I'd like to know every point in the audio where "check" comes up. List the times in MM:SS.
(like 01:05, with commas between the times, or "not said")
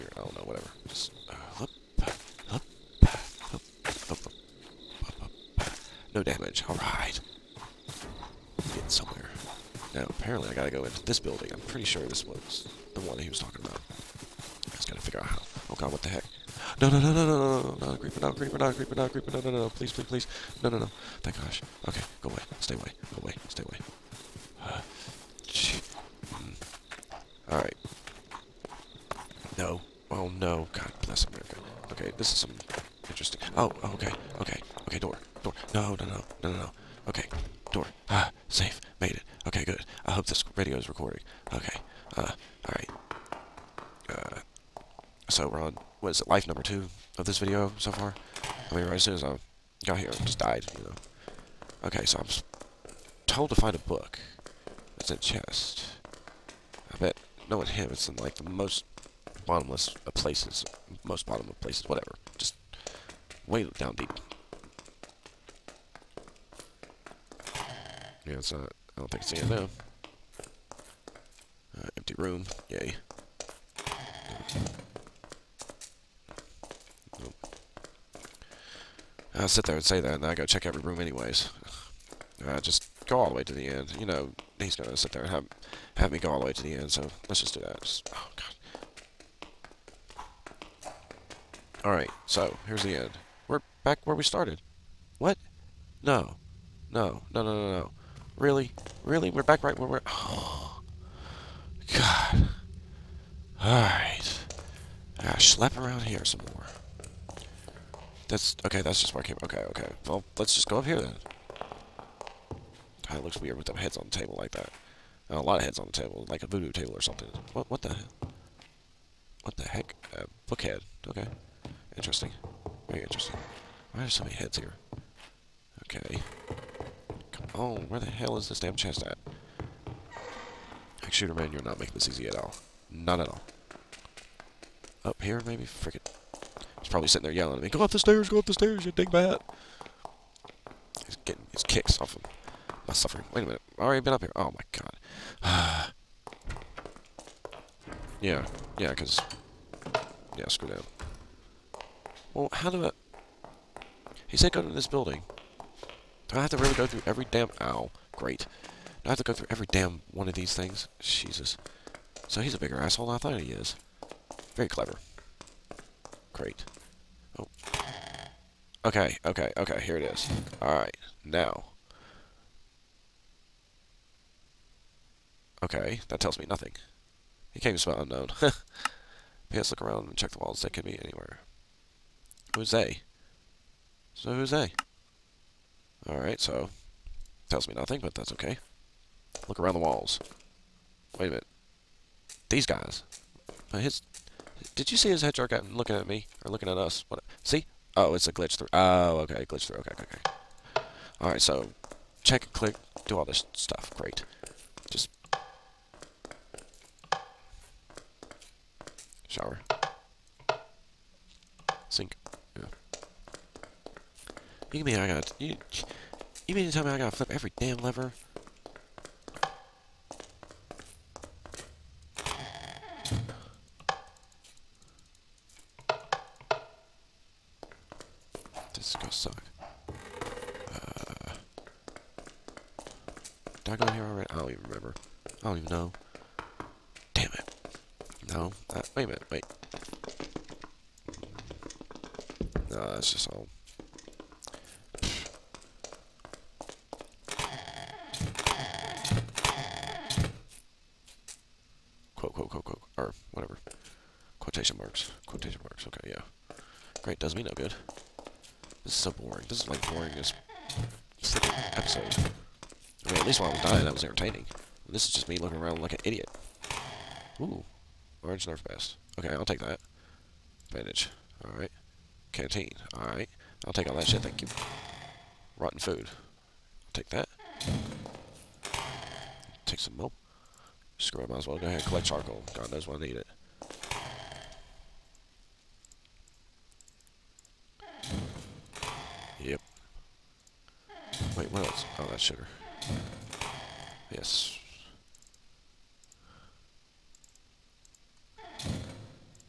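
01:20, 03:00, 03:22.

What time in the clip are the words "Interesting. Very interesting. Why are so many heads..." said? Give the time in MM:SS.
02:01.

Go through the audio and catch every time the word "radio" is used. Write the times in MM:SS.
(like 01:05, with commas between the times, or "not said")
00:40.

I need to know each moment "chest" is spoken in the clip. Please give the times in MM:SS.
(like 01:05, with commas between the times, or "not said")
00:55, 02:08.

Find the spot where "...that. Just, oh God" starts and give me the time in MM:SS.
01:27.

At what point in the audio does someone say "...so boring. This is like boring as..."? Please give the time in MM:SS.
04:18.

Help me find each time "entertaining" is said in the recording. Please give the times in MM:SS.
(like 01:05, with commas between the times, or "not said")
04:24.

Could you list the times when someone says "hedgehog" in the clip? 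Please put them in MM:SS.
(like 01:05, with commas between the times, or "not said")
03:15.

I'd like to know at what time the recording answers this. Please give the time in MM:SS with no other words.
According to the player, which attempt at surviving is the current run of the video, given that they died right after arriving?
00:46.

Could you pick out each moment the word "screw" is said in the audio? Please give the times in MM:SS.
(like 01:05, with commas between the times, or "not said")
02:30, 04:40.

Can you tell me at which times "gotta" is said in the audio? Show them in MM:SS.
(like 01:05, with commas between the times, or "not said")
00:10, 00:14, 03:36.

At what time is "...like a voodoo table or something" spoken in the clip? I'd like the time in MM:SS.
01:56.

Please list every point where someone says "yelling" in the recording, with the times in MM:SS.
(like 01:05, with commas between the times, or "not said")
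02:17.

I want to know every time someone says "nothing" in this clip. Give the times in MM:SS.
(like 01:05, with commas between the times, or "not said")
02:56, 03:07.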